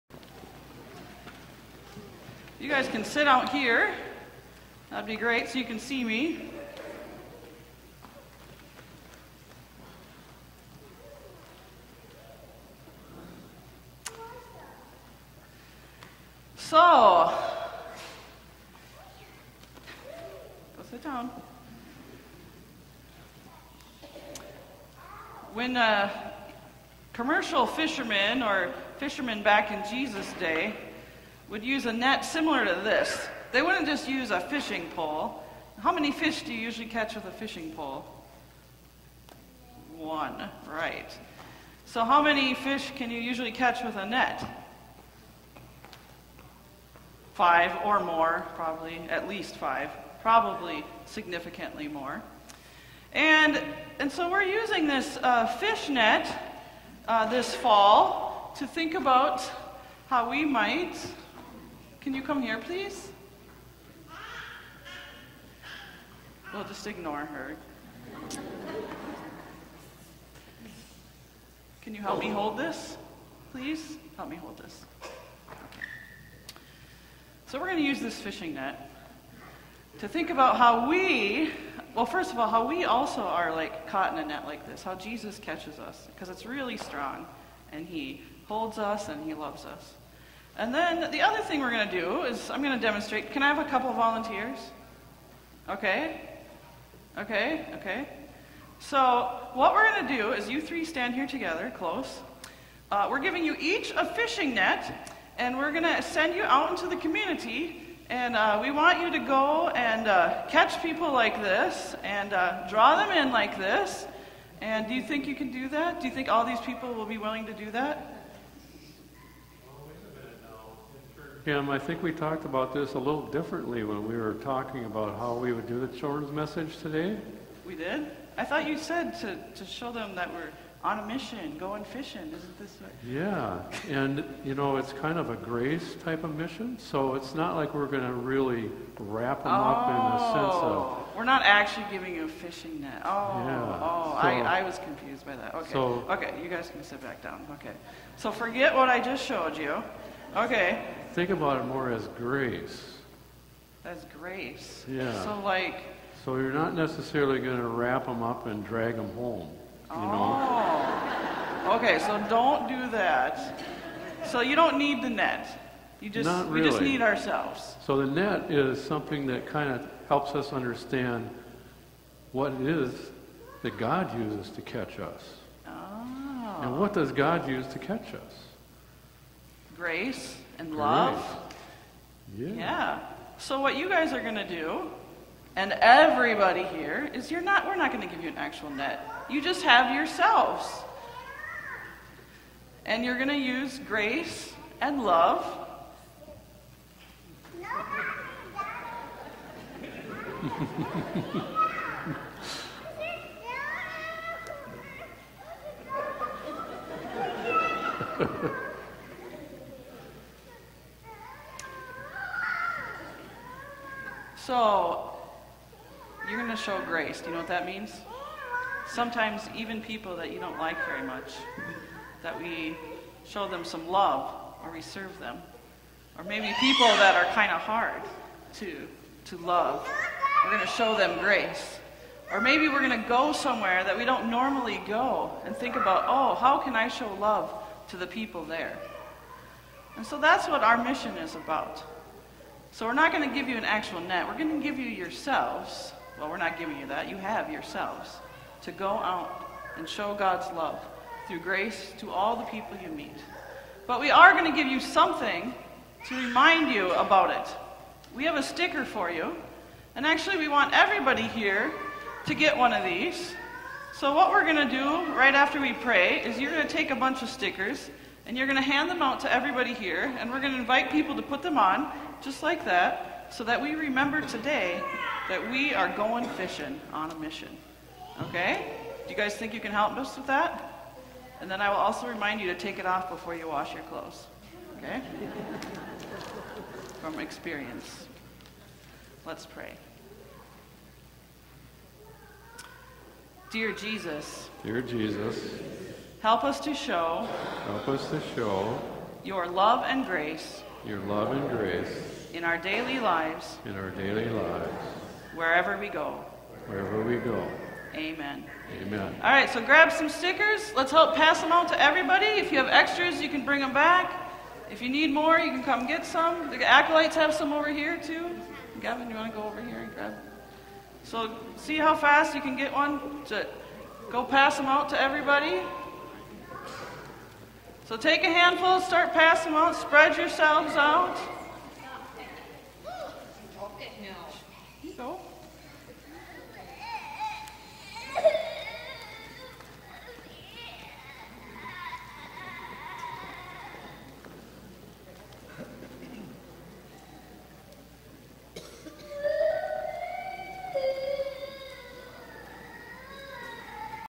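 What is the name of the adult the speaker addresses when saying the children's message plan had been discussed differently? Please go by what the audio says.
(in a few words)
Kim.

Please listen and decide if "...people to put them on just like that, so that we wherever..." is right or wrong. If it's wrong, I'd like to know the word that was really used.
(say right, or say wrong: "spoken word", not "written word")
wrong: "remember", not "wherever".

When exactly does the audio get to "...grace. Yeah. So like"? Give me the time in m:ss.
2:34.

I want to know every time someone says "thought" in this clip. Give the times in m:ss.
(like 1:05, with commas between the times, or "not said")
2:08.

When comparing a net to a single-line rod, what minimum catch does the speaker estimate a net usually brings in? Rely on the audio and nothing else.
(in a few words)
5.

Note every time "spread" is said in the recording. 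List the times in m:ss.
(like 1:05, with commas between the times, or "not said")
5:29.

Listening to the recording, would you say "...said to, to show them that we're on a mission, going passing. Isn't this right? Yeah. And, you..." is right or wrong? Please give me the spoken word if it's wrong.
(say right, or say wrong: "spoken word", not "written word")
wrong: "fishing", not "passing".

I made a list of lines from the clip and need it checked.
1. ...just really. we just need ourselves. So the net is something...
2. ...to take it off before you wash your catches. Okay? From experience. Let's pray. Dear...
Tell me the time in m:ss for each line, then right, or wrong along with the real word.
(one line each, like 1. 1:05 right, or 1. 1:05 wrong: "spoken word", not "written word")
1. 2:46 right
2. 4:42 wrong: "clothes", not "catches".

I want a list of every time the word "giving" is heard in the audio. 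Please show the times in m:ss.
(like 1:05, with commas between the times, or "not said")
1:43, 2:21, 4:06.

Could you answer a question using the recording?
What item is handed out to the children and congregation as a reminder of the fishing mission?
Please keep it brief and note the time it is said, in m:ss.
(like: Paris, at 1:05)
A sticker, at 4:18.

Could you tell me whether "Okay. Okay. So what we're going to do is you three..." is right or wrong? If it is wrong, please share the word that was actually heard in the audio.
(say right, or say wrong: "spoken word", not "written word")
right.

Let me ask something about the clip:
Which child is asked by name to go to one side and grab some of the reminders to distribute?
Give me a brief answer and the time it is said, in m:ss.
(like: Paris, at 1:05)
Gavin, at 5:18.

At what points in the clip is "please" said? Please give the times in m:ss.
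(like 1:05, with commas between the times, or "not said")
1:02, 1:13.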